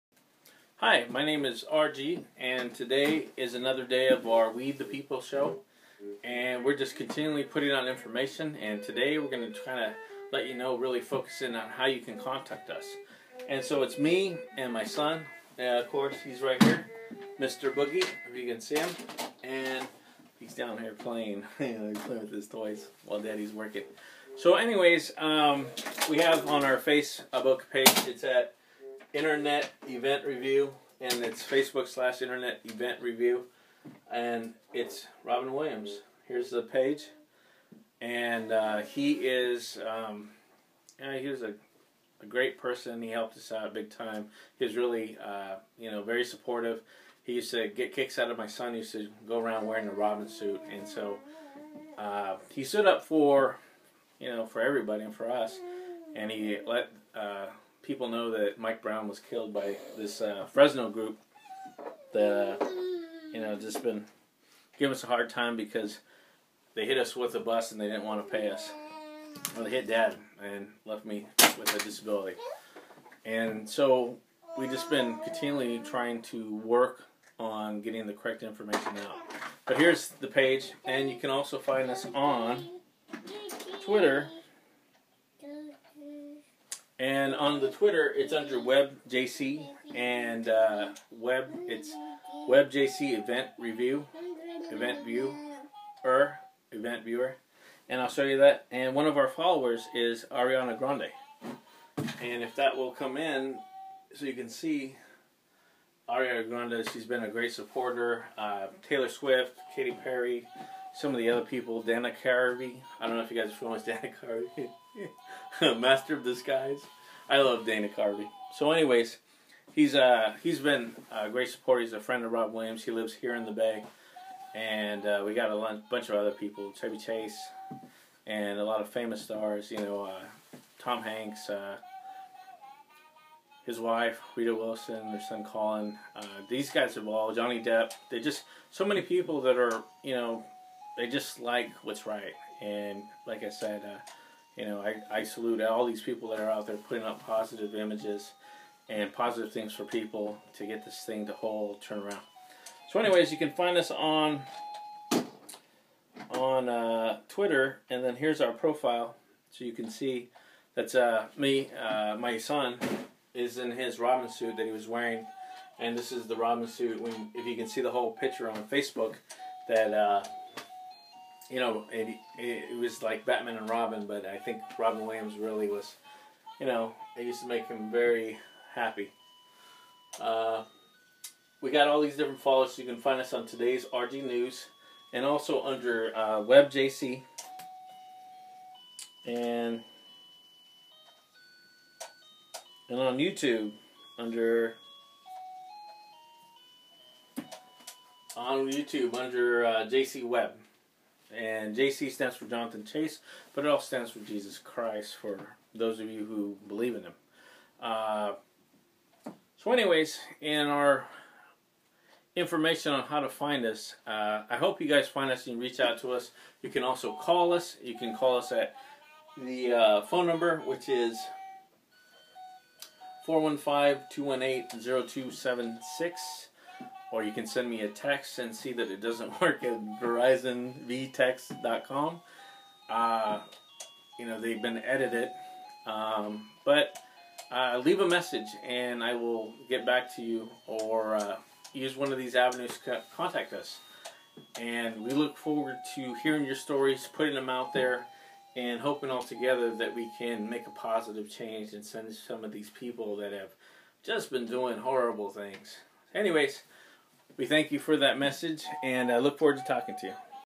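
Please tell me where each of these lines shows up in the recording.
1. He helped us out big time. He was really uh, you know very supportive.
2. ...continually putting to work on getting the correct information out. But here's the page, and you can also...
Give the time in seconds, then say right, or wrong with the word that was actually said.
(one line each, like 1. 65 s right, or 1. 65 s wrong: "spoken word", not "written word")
1. 43 s right
2. 75 s wrong: "trying", not "putting".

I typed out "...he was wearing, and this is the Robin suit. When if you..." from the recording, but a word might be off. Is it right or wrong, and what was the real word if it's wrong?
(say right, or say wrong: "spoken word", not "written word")
right.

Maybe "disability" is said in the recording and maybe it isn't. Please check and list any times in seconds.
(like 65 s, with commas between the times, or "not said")
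71 s.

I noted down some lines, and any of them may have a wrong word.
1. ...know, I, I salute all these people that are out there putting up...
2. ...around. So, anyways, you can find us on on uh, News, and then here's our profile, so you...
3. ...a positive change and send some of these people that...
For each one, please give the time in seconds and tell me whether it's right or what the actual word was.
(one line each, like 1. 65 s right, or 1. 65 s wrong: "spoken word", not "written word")
1. 144 s right
2. 151 s wrong: "Twitter", not "News"
3. 250 s right.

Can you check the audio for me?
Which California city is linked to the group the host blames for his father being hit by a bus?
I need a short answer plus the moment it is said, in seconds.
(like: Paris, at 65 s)
Fresno, at 60 s.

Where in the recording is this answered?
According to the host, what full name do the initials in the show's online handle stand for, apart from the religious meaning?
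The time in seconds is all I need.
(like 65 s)
202 s.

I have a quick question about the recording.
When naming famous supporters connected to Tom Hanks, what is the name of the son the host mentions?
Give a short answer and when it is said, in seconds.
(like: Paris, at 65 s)
Colin, at 135 s.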